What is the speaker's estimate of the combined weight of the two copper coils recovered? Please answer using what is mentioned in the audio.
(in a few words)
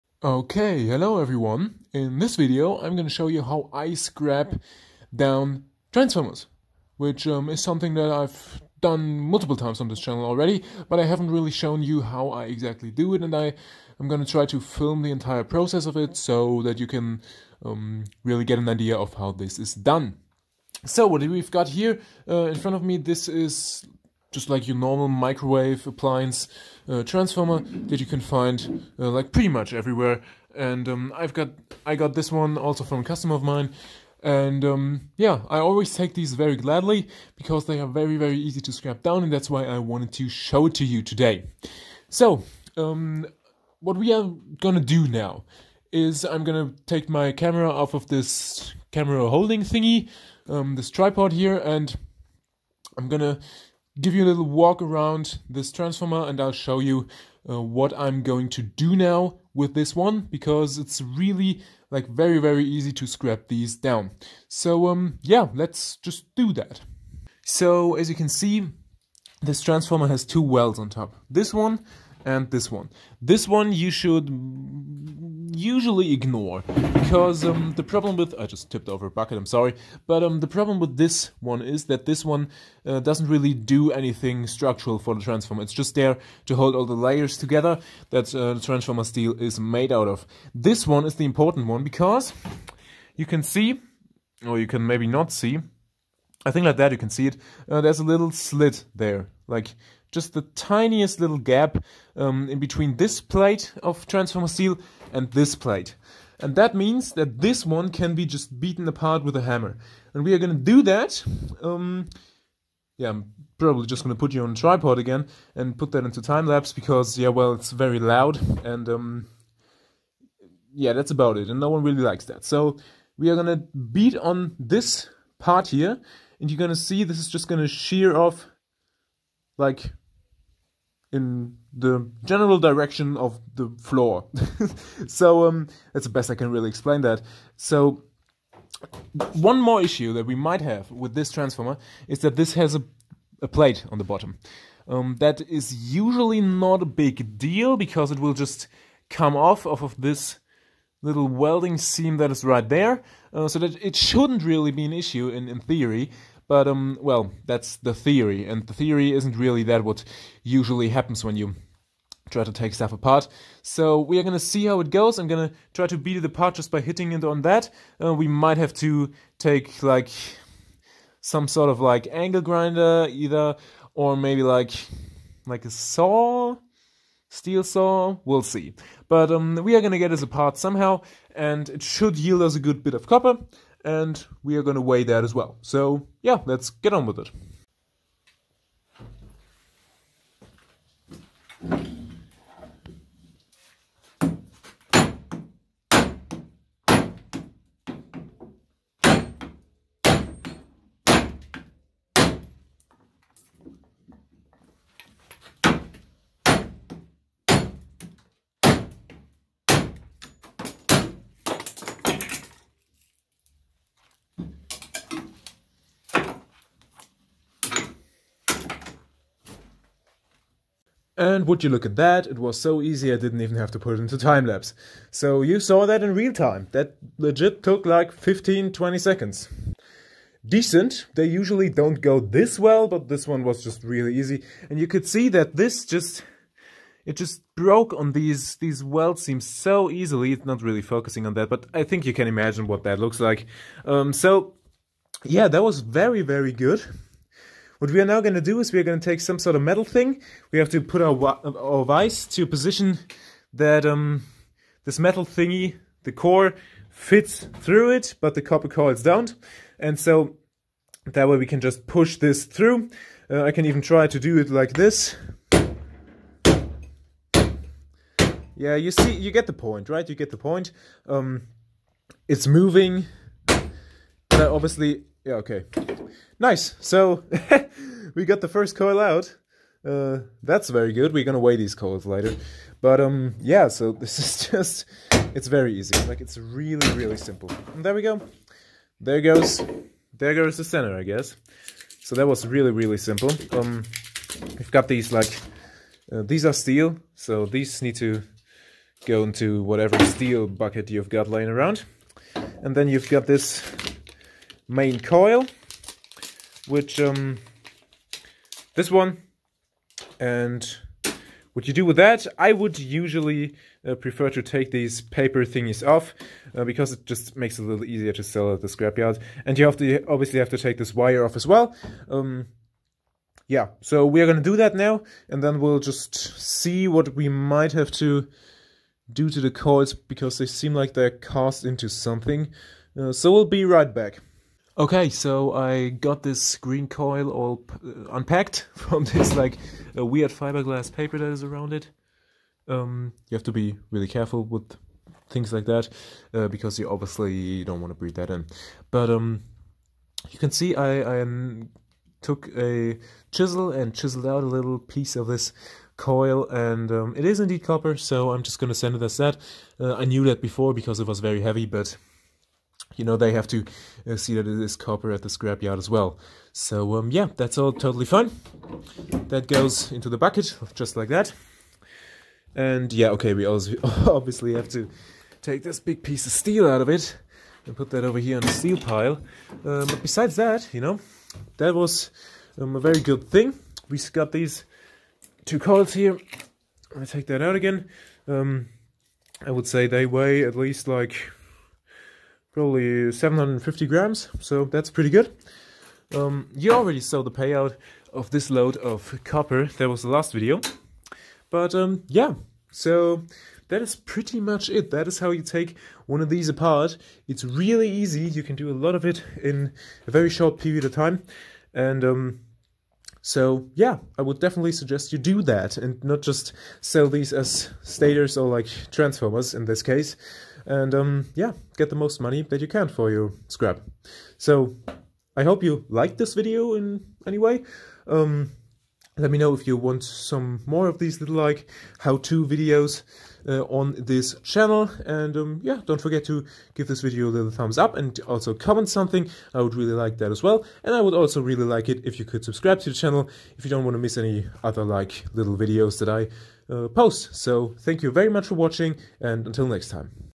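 750 grams.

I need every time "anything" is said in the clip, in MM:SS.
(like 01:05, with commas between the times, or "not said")
01:23.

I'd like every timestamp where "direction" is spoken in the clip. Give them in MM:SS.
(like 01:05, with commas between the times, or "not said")
02:12.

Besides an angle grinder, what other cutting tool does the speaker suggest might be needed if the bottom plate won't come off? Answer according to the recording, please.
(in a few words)
steel saw.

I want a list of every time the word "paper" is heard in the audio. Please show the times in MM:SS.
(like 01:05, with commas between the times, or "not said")
05:15, 05:40.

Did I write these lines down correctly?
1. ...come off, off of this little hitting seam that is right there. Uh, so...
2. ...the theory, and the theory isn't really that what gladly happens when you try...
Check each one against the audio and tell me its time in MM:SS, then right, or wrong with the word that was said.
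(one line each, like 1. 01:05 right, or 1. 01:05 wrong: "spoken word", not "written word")
1. 02:29 wrong: "welding", not "hitting"
2. 02:37 wrong: "usually", not "gladly".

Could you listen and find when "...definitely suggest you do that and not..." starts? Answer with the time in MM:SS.
06:54.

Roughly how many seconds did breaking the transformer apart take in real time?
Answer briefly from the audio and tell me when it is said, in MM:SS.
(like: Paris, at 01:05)
15-20 seconds, at 03:48.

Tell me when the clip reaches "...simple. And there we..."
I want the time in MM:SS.
04:47.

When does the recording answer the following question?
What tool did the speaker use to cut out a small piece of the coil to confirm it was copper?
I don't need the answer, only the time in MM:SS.
05:53.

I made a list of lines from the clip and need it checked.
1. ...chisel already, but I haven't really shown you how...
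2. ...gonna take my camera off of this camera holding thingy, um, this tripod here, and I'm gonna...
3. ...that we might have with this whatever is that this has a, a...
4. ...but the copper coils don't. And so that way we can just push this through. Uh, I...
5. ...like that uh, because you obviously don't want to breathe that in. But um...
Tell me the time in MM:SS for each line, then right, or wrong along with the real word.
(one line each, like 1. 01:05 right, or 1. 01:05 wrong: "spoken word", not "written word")
1. 00:09 wrong: "channel", not "chisel"
2. 00:46 right
3. 02:20 wrong: "transformer", not "whatever"
4. 04:18 right
5. 05:45 right.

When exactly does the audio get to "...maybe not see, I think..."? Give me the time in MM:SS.
01:34.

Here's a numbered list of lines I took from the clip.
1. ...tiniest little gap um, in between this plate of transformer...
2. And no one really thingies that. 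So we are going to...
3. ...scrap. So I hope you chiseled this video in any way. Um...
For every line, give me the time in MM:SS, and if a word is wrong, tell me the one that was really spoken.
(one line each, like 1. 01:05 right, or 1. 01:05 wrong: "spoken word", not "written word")
1. 01:40 right
2. 02:01 wrong: "likes", not "thingies"
3. 07:03 wrong: "liked", not "chiseled".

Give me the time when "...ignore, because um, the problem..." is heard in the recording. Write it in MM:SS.
01:16.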